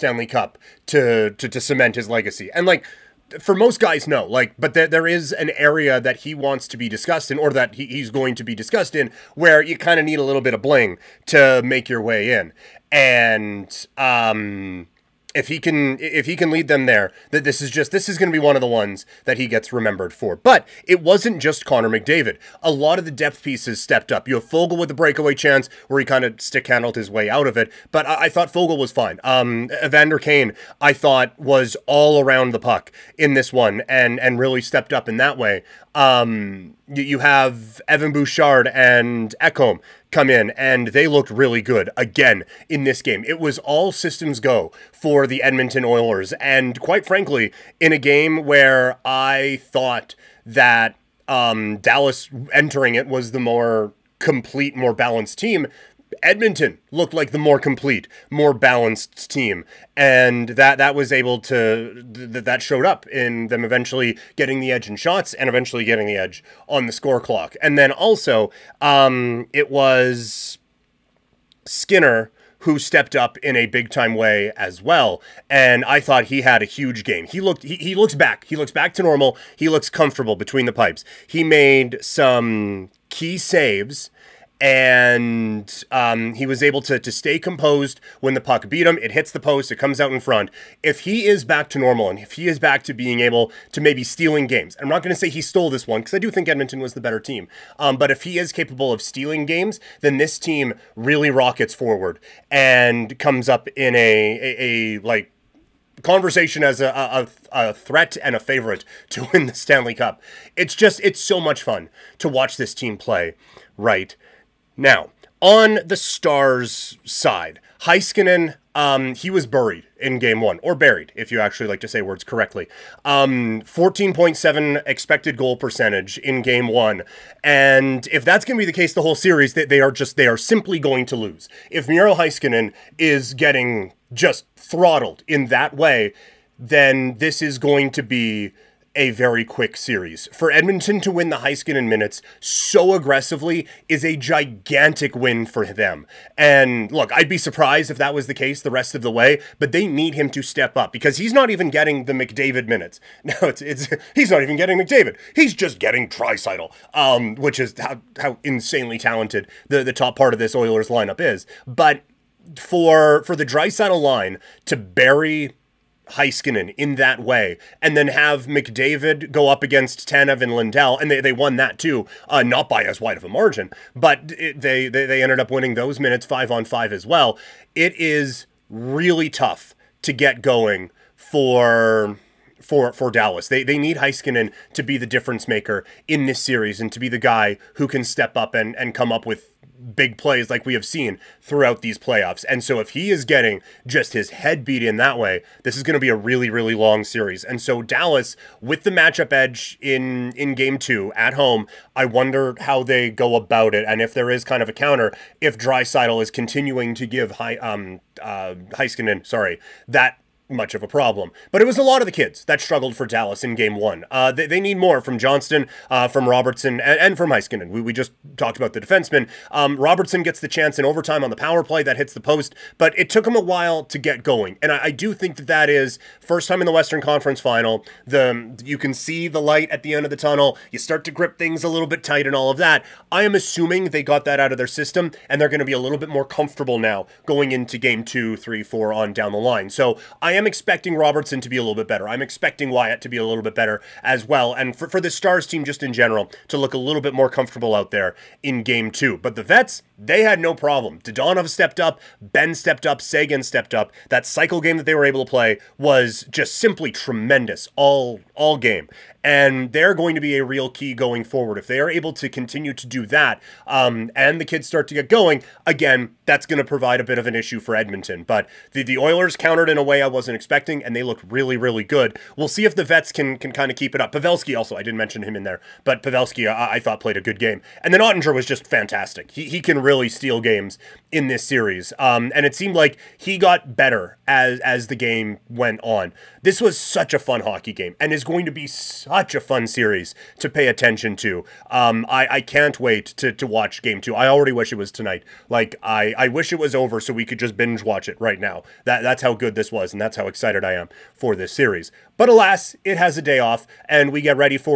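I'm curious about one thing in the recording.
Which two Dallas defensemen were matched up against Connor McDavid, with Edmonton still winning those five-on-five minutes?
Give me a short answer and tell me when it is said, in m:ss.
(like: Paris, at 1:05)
Tanev and Lindell, at 2:50.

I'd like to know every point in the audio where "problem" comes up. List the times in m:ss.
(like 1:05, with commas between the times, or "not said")
3:30, 4:10.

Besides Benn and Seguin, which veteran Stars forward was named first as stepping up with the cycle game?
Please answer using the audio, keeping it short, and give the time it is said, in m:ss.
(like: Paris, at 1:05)
Dadonov, at 4:11.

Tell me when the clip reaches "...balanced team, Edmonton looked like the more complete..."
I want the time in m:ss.
0:54.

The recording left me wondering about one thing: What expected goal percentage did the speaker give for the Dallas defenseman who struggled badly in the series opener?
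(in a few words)
14.7.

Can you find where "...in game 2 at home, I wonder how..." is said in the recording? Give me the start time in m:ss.
3:20.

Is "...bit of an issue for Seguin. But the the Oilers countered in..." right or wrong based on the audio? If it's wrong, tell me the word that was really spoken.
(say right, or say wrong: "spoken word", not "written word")
wrong: "Edmonton", not "Seguin".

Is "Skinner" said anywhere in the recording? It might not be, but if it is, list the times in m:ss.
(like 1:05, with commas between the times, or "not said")
1:11.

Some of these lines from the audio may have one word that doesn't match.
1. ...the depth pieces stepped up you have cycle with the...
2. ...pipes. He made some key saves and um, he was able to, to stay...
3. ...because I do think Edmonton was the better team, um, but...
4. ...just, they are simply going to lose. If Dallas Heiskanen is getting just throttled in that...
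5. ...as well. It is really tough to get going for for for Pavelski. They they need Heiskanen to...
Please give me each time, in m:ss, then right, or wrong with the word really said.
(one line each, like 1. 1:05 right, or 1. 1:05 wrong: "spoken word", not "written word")
1. 0:23 wrong: "foegele", not "cycle"
2. 1:20 right
3. 1:36 right
4. 2:09 wrong: "Miro", not "Dallas"
5. 2:56 wrong: "Dallas", not "Pavelski".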